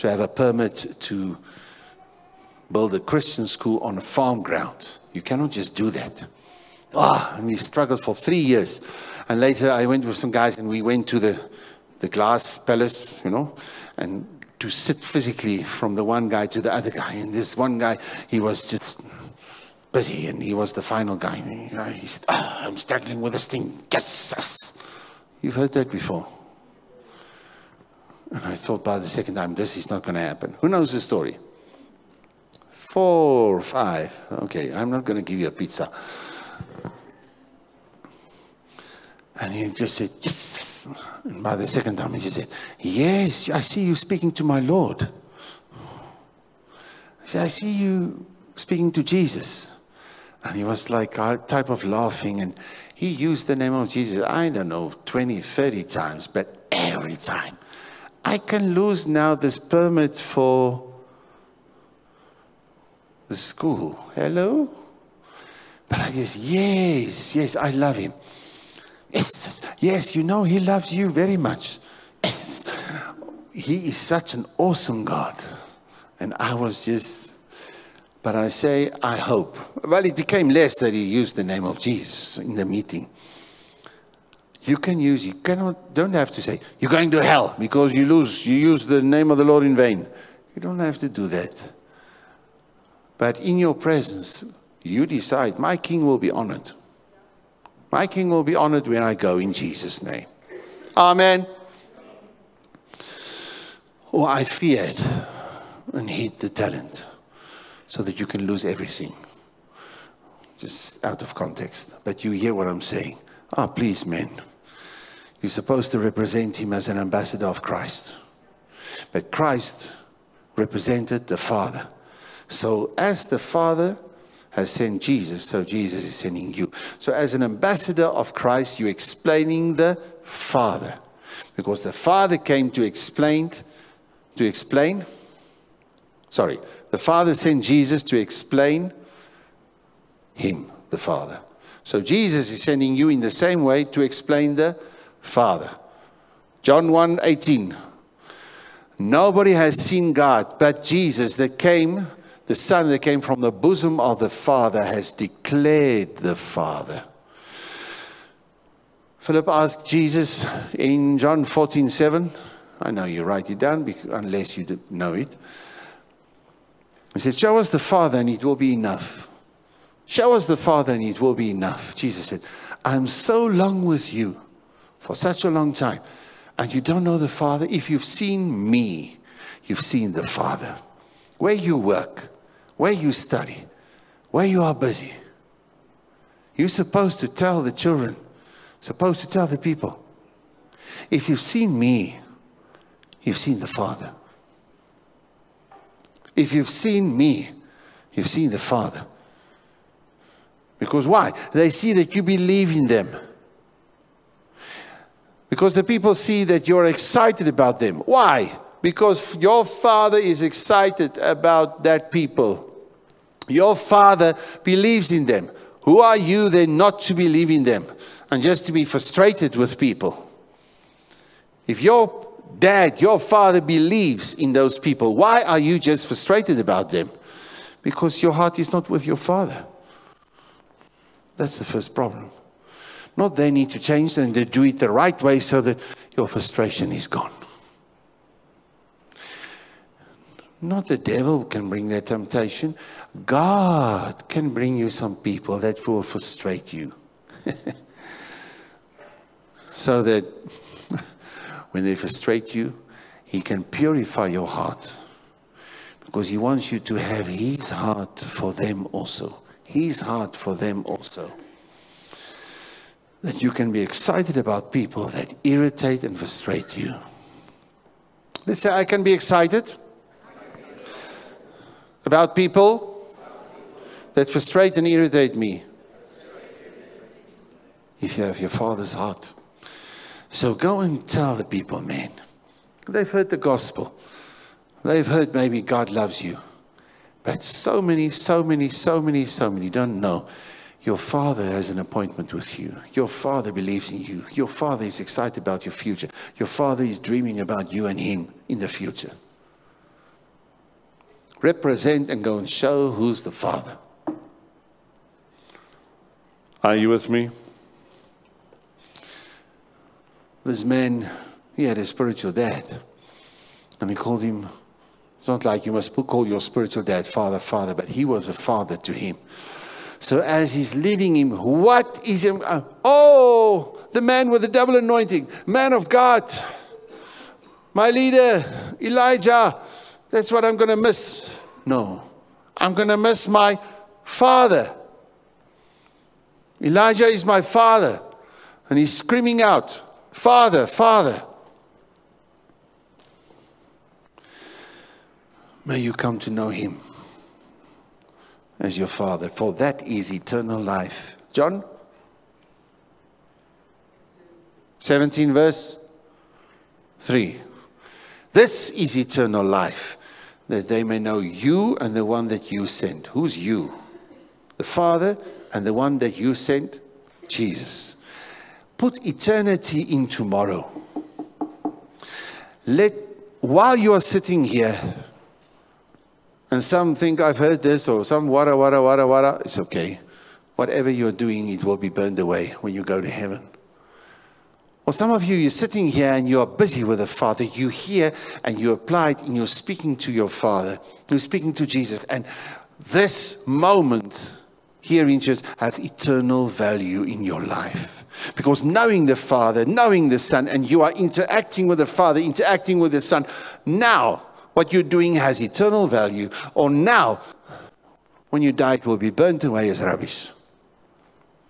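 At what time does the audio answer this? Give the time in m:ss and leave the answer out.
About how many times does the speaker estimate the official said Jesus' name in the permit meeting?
0:55.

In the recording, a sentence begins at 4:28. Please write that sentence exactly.
Let's say, I can be excited about people that frustrate and irritate me if you have your Father's heart.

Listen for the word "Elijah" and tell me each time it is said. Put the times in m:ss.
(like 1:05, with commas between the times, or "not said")
5:28, 5:36.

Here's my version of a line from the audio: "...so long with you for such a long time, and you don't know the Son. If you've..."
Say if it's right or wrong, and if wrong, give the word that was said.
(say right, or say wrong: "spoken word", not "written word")
wrong: "Father", not "Son".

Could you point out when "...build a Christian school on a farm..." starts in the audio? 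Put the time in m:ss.
0:02.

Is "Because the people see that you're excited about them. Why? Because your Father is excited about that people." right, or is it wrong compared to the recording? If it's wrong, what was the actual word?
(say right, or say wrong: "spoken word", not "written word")
right.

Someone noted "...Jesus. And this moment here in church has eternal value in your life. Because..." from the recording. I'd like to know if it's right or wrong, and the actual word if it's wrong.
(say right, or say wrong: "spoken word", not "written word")
right.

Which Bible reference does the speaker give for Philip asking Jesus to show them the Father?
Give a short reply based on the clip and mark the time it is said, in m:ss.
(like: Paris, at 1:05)
John 14:7, at 2:41.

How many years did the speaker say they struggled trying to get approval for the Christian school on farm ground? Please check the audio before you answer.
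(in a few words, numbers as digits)
3.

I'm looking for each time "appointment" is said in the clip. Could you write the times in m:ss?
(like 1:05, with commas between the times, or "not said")
4:51.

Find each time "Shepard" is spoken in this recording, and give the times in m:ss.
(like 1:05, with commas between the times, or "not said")
not said.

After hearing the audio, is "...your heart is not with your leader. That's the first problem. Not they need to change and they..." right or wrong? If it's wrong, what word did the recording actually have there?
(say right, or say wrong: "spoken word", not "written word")
wrong: "father", not "leader".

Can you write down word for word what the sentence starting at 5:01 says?
Represent and go and show who's the father.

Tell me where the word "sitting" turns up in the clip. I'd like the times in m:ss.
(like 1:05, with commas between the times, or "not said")
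6:14, 6:25.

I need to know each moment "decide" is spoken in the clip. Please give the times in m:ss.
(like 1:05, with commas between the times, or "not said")
1:35.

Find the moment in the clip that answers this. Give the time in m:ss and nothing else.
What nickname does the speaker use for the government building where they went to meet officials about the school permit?
0:11.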